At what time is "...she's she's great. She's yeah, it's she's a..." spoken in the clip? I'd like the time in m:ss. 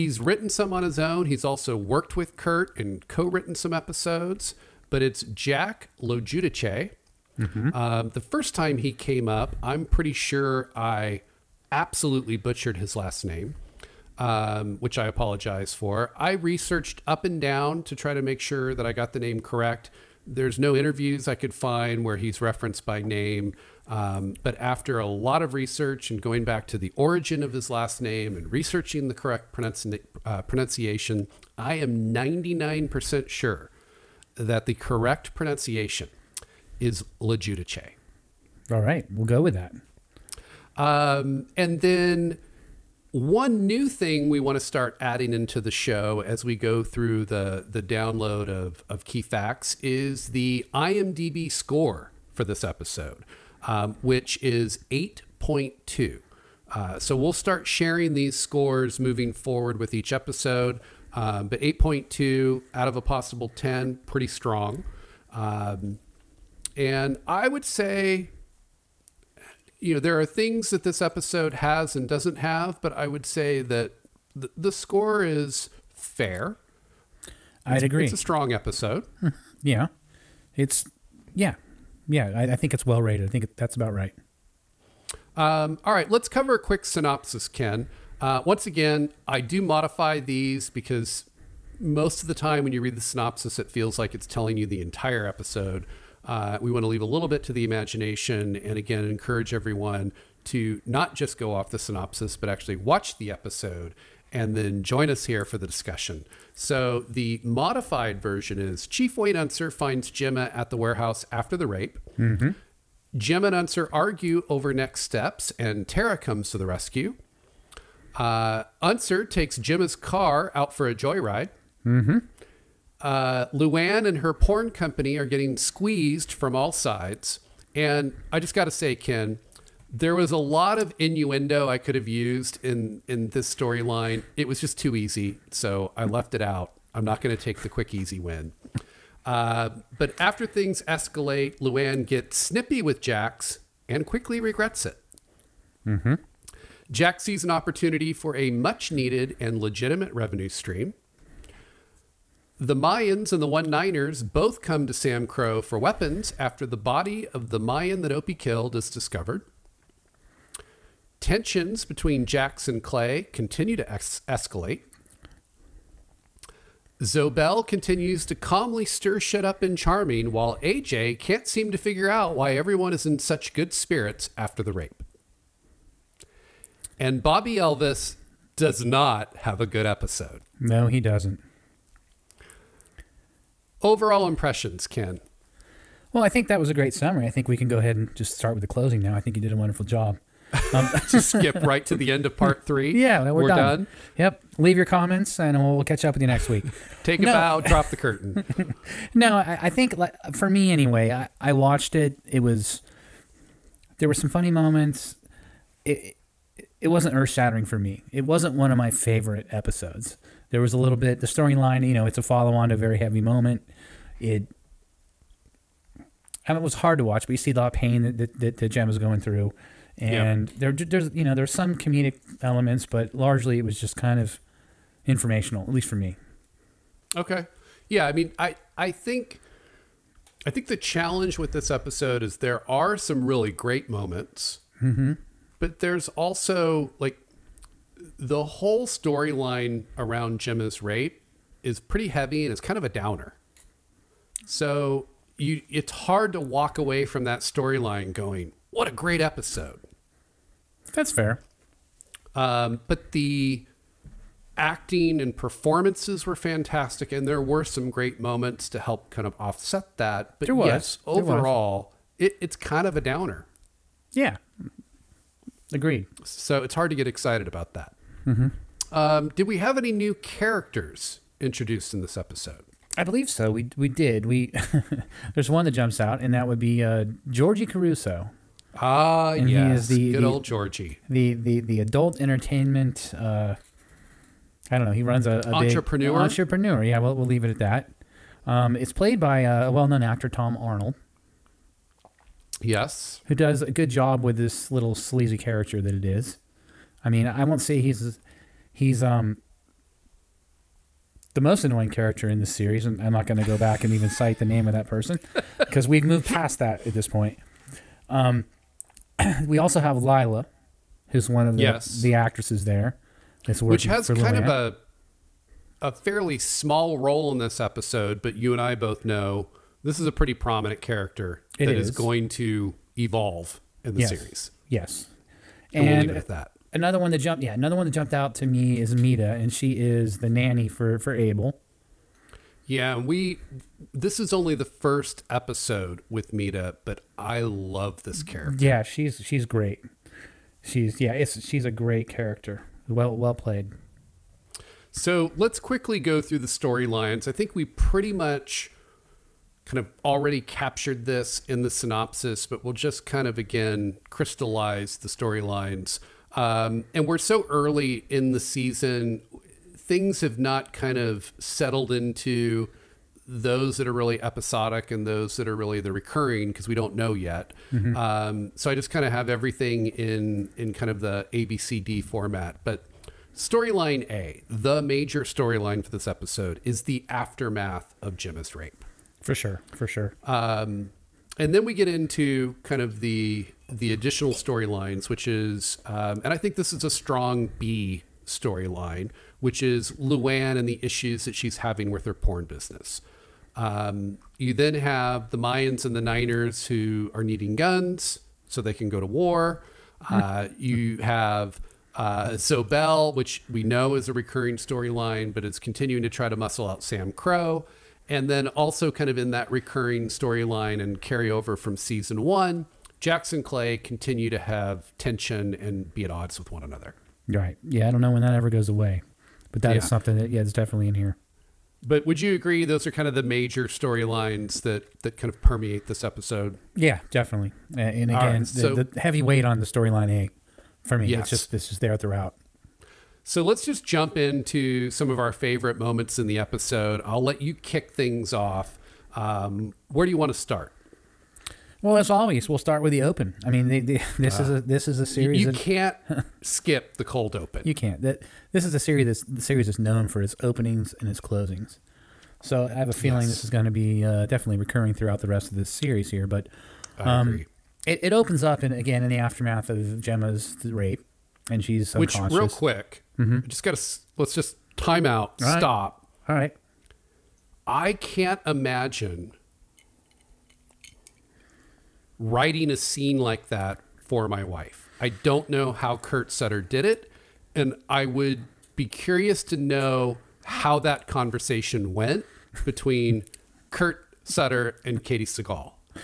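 5:38.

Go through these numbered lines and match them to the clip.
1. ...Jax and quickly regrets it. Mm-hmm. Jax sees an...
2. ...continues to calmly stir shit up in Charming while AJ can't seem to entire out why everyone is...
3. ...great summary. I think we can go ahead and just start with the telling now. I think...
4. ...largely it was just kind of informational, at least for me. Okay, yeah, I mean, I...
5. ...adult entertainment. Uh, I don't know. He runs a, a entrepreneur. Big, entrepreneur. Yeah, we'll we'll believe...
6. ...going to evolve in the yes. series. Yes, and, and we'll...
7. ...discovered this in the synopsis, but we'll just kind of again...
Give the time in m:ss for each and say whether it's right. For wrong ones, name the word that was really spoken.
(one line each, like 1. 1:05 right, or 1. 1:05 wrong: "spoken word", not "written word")
1. 2:23 right
2. 2:47 wrong: "figure", not "entire"
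3. 3:06 wrong: "closing", not "telling"
4. 3:43 right
5. 4:41 wrong: "leave", not "believe"
6. 5:21 right
7. 5:50 wrong: "captured", not "discovered".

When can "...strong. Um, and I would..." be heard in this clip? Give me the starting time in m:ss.
1:04.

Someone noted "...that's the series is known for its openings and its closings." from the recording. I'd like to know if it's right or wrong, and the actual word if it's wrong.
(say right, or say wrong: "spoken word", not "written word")
right.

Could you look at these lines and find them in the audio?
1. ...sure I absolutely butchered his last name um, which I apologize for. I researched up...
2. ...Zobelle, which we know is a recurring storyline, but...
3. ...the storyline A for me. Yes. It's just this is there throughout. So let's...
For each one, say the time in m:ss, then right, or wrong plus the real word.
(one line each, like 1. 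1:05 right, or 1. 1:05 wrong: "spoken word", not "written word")
1. 0:10 right
2. 6:42 right
3. 7:09 right.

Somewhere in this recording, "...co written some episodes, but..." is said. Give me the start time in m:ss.
0:03.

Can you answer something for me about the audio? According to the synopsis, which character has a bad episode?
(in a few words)
Bobby Elvis.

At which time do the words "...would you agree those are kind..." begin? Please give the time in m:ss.
7:02.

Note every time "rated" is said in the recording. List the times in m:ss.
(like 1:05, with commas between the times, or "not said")
1:23.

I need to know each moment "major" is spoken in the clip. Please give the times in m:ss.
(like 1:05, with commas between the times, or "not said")
6:14, 7:03.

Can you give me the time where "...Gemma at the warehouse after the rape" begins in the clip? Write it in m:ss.
1:50.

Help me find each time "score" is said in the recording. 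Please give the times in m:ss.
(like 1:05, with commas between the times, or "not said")
0:51, 0:58, 1:14.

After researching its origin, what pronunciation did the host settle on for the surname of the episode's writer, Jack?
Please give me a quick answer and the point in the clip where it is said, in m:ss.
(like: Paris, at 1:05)
Lejudice, at 0:37.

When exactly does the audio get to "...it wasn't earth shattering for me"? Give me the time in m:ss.
3:26.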